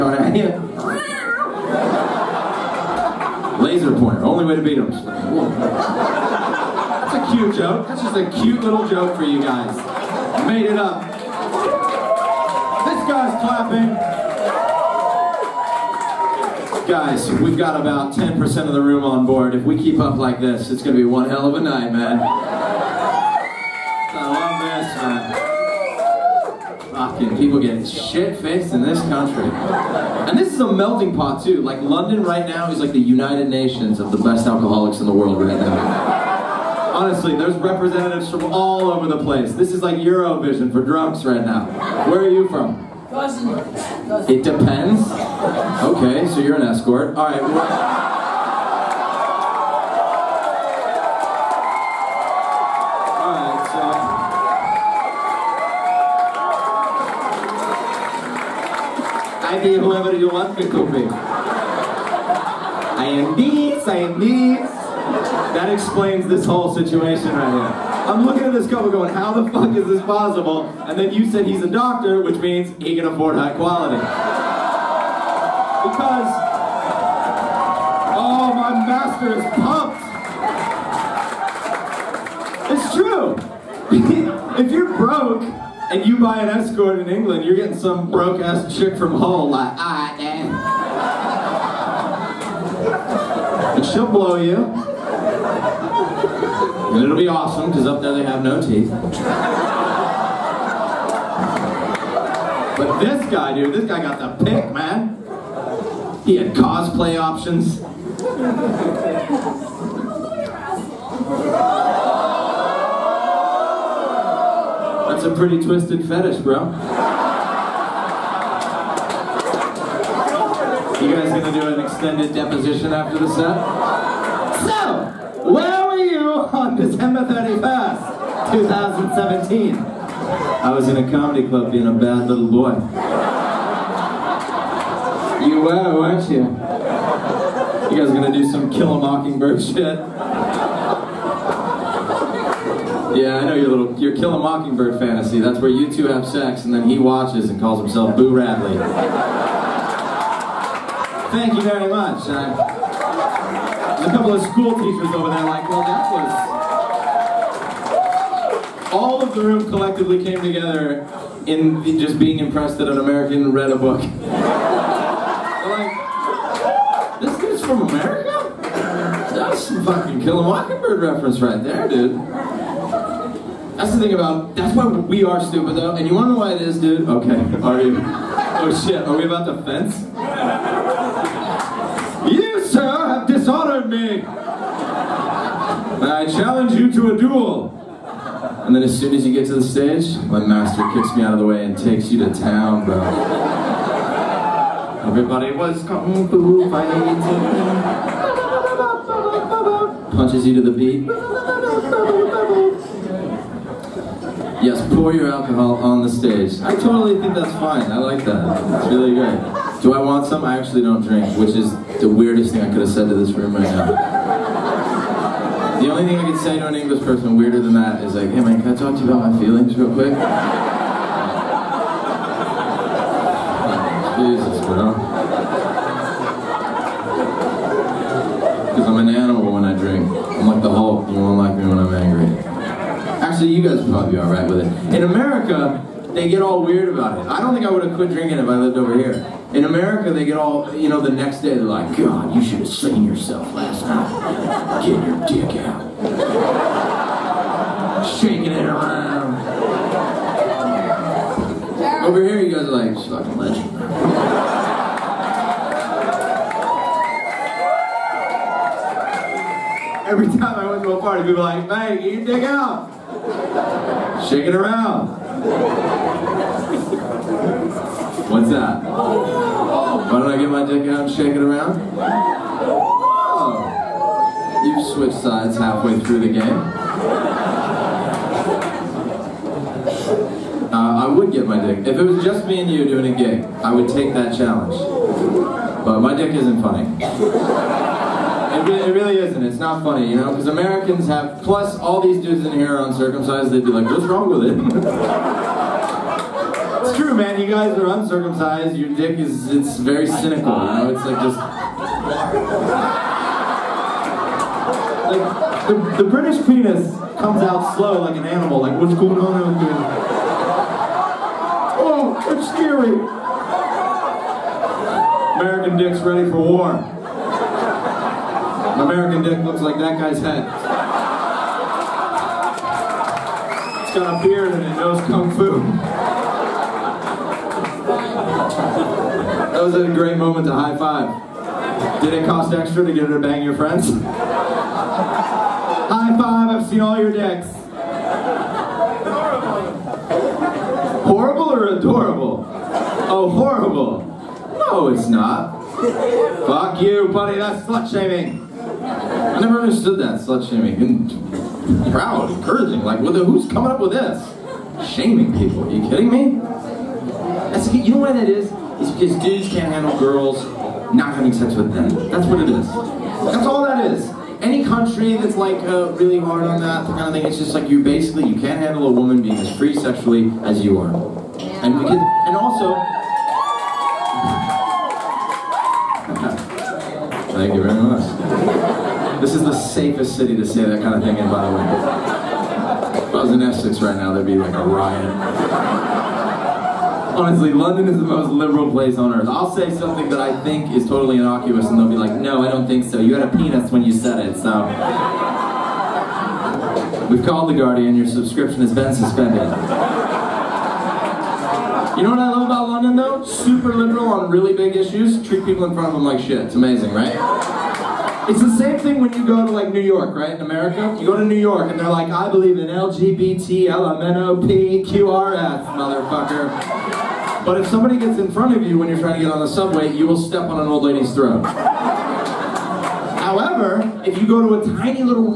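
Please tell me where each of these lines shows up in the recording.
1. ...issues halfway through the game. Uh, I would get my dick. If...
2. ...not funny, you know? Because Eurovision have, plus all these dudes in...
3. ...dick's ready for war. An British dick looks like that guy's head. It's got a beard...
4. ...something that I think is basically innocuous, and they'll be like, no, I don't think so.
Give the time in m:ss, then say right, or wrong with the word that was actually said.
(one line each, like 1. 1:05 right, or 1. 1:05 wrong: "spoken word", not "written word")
1. 4:35 wrong: "sides", not "issues"
2. 4:49 wrong: "Americans", not "Eurovision"
3. 5:15 wrong: "American", not "British"
4. 6:29 wrong: "totally", not "basically".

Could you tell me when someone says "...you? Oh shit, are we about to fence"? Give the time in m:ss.
2:57.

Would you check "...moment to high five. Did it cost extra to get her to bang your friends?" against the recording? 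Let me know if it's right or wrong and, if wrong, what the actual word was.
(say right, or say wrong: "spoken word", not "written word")
right.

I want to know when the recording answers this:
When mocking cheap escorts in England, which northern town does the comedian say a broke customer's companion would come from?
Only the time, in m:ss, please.
1:29.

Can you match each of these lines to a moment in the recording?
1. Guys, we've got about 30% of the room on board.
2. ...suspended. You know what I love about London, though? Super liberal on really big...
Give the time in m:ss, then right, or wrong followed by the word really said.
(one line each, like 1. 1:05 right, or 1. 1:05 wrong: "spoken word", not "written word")
1. 0:16 wrong: "10", not "30"
2. 6:38 right.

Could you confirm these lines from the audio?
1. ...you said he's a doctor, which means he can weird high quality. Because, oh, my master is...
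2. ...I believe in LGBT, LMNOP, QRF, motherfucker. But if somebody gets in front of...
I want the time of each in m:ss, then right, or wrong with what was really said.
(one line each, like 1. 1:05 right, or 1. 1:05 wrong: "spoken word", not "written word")
1. 1:11 wrong: "afford", not "weird"
2. 6:52 right.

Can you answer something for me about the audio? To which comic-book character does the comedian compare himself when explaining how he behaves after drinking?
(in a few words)
The Hulk.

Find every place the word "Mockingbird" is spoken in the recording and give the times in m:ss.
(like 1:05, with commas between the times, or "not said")
2:18, 2:24, 2:50.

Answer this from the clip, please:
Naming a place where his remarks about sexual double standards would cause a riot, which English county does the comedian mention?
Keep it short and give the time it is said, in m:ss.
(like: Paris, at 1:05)
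Essex, at 6:23.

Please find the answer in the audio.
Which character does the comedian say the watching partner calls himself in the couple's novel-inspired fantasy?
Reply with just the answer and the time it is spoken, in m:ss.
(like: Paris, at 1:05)
Boo Radley, at 2:28.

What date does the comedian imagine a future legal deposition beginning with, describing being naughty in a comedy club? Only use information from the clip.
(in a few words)
December 31st, 2017.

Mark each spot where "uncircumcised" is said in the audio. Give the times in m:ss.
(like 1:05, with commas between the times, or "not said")
4:52, 4:57.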